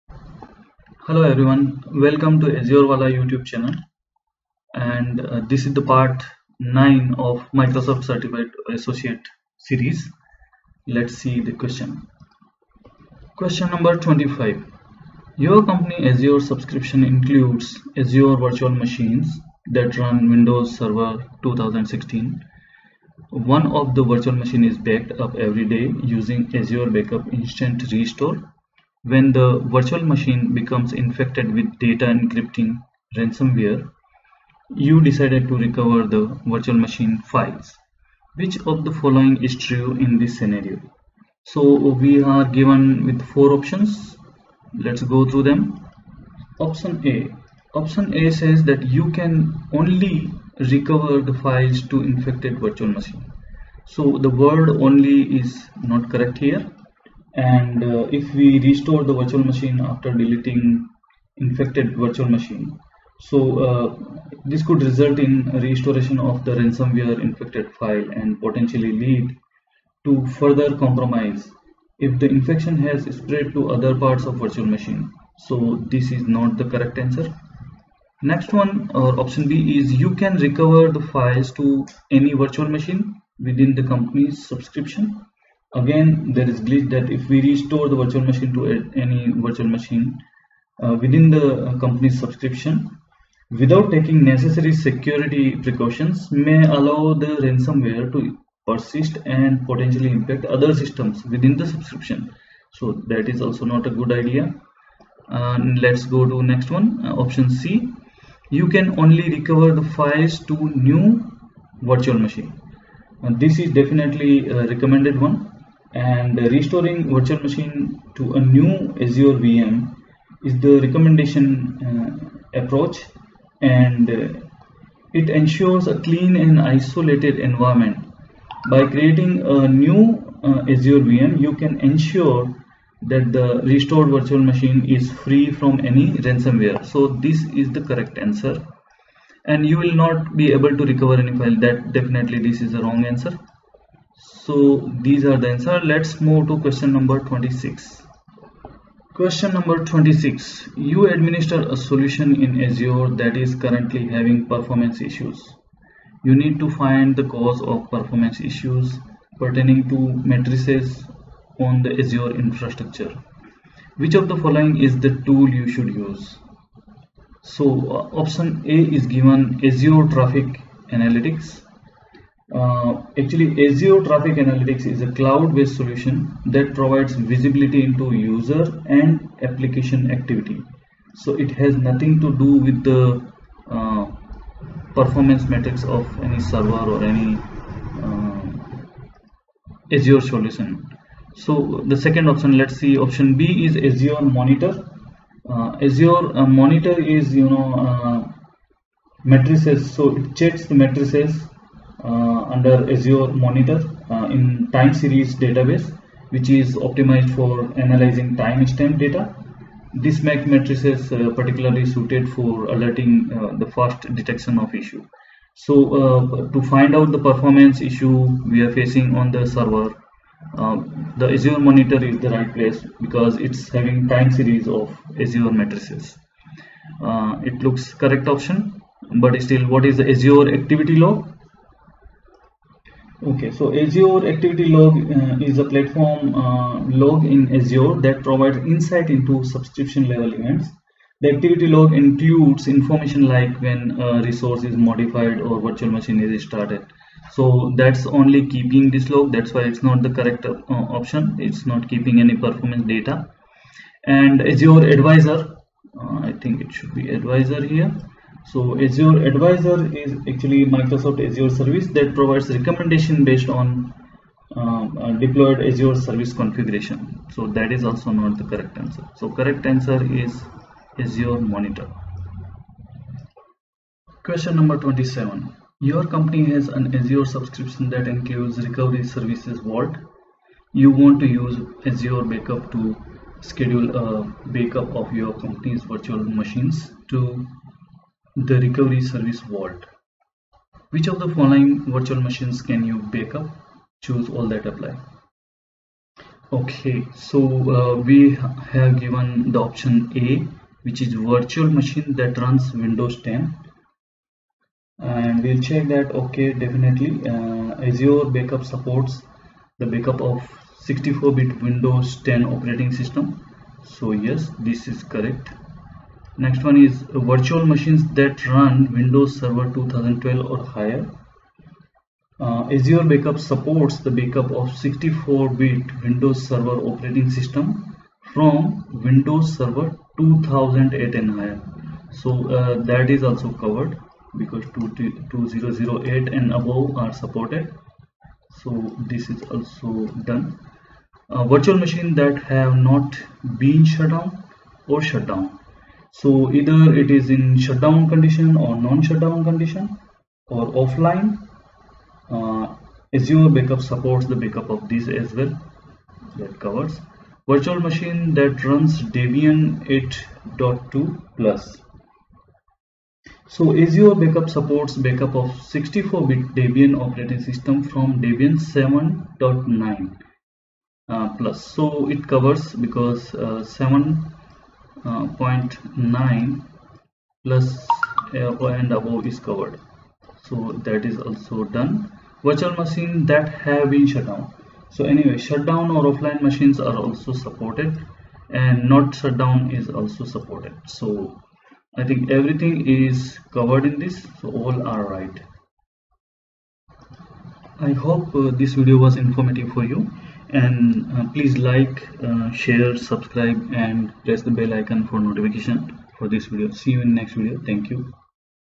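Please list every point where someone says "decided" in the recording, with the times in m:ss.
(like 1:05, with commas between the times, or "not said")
0:35.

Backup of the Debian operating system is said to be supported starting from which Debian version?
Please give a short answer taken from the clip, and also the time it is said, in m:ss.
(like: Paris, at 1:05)
7.9, at 6:08.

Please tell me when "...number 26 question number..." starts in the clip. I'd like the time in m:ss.
2:26.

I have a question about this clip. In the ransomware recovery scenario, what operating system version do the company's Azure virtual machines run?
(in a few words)
Windows Server 2016.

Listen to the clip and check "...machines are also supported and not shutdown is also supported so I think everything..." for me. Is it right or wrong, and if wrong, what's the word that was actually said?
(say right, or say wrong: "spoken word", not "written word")
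right.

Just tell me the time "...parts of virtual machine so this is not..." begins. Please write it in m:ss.
1:13.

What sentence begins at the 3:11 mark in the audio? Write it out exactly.
So the second option, let's see, option B is Azure Monitor.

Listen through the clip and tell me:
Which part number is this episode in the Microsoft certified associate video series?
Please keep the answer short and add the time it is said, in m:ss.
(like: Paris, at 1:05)
9, at 0:05.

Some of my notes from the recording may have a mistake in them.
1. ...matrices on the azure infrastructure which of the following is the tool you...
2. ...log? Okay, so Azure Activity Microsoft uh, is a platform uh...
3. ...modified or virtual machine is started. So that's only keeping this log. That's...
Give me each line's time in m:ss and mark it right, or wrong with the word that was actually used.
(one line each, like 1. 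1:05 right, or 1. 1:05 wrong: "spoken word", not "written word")
1. 2:40 right
2. 3:50 wrong: "Log", not "Microsoft"
3. 4:04 right.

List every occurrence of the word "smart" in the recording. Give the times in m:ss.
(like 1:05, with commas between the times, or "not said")
not said.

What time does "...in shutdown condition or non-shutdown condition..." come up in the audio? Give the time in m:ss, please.
5:47.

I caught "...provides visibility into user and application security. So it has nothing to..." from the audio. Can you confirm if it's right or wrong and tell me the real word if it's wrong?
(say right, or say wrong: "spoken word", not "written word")
wrong: "activity", not "security".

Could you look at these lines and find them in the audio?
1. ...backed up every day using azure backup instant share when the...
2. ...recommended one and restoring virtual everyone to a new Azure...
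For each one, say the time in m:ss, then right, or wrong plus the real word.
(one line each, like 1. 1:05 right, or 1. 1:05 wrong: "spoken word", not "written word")
1. 0:24 wrong: "restore", not "share"
2. 1:54 wrong: "machine", not "everyone".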